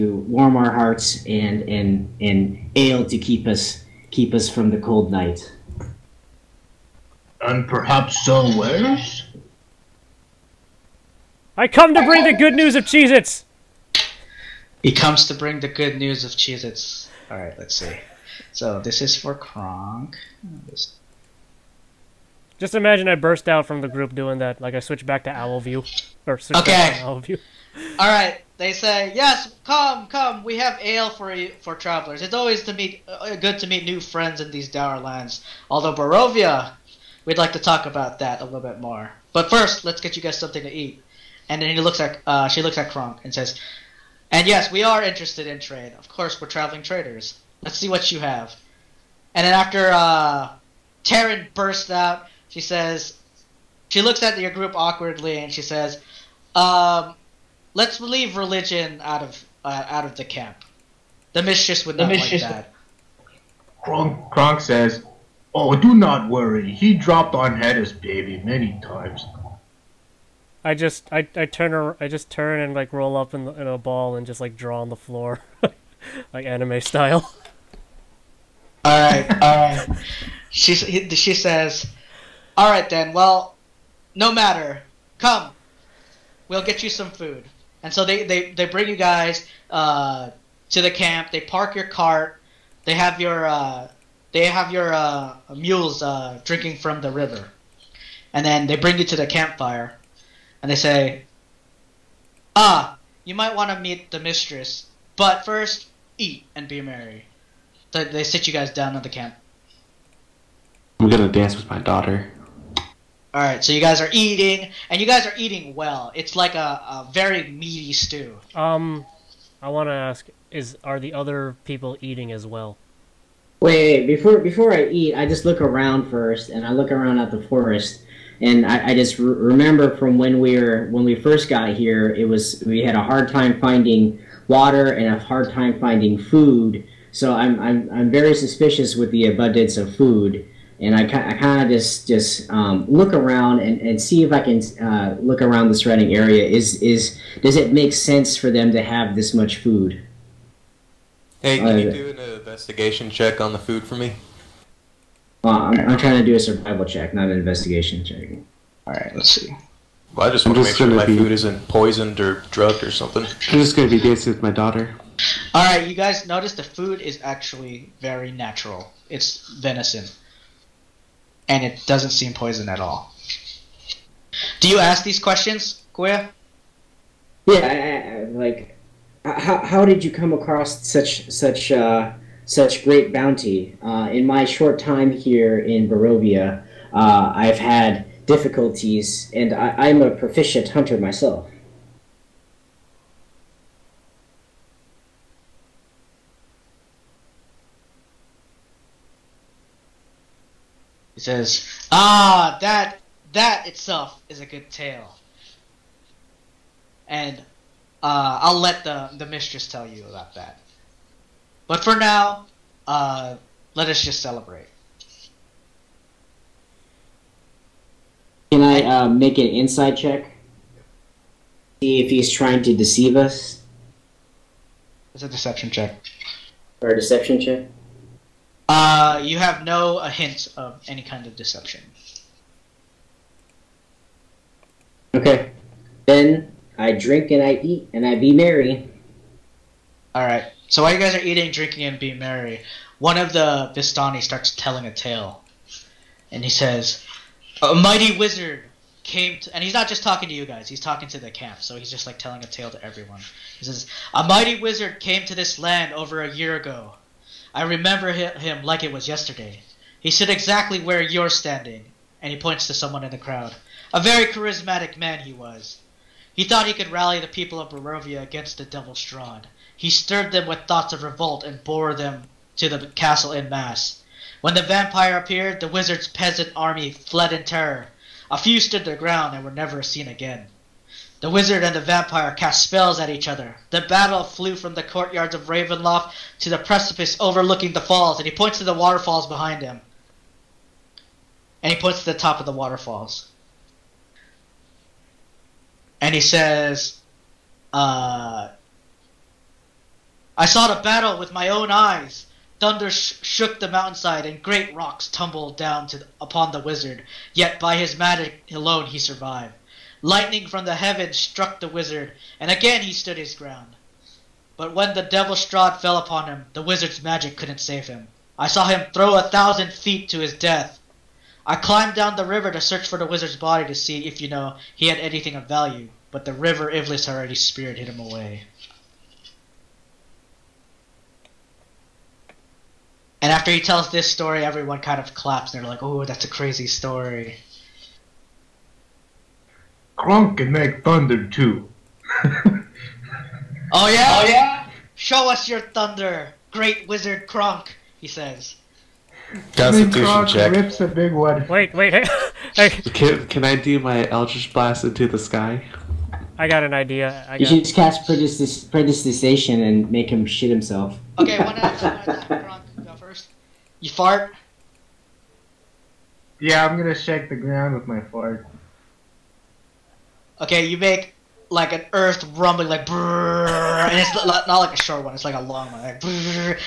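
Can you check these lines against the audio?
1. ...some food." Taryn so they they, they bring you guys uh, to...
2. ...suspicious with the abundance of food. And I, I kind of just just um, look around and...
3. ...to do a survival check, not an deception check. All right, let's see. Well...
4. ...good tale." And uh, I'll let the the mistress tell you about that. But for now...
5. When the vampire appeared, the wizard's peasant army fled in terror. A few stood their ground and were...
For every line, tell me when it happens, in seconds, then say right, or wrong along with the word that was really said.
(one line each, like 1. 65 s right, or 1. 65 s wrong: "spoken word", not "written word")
1. 86 s wrong: "And", not "Taryn"
2. 138 s right
3. 156 s wrong: "investigation", not "deception"
4. 204 s right
5. 274 s right.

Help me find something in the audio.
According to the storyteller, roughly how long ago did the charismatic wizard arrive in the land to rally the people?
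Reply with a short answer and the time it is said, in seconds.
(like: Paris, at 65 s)
Over a year ago, at 255 s.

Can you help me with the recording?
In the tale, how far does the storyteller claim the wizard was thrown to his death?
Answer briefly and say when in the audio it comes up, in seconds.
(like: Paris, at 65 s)
1000 feet, at 319 s.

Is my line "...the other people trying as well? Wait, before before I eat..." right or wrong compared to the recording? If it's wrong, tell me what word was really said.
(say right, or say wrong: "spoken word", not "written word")
wrong: "eating", not "trying".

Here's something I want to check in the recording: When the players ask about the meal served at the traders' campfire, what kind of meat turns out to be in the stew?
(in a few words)
Venison.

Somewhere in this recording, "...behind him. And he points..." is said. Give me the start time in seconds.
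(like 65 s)
289 s.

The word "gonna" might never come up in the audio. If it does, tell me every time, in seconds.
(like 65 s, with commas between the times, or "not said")
111 s, 366 s.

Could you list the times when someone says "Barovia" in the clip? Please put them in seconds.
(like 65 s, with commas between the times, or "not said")
35 s, 185 s, 267 s.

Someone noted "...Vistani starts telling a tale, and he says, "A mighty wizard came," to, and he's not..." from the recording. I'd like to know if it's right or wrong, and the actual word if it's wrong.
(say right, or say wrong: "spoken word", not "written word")
right.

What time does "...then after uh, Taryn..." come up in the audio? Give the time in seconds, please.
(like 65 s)
49 s.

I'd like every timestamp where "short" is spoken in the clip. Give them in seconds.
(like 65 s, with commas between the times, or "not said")
184 s, 374 s.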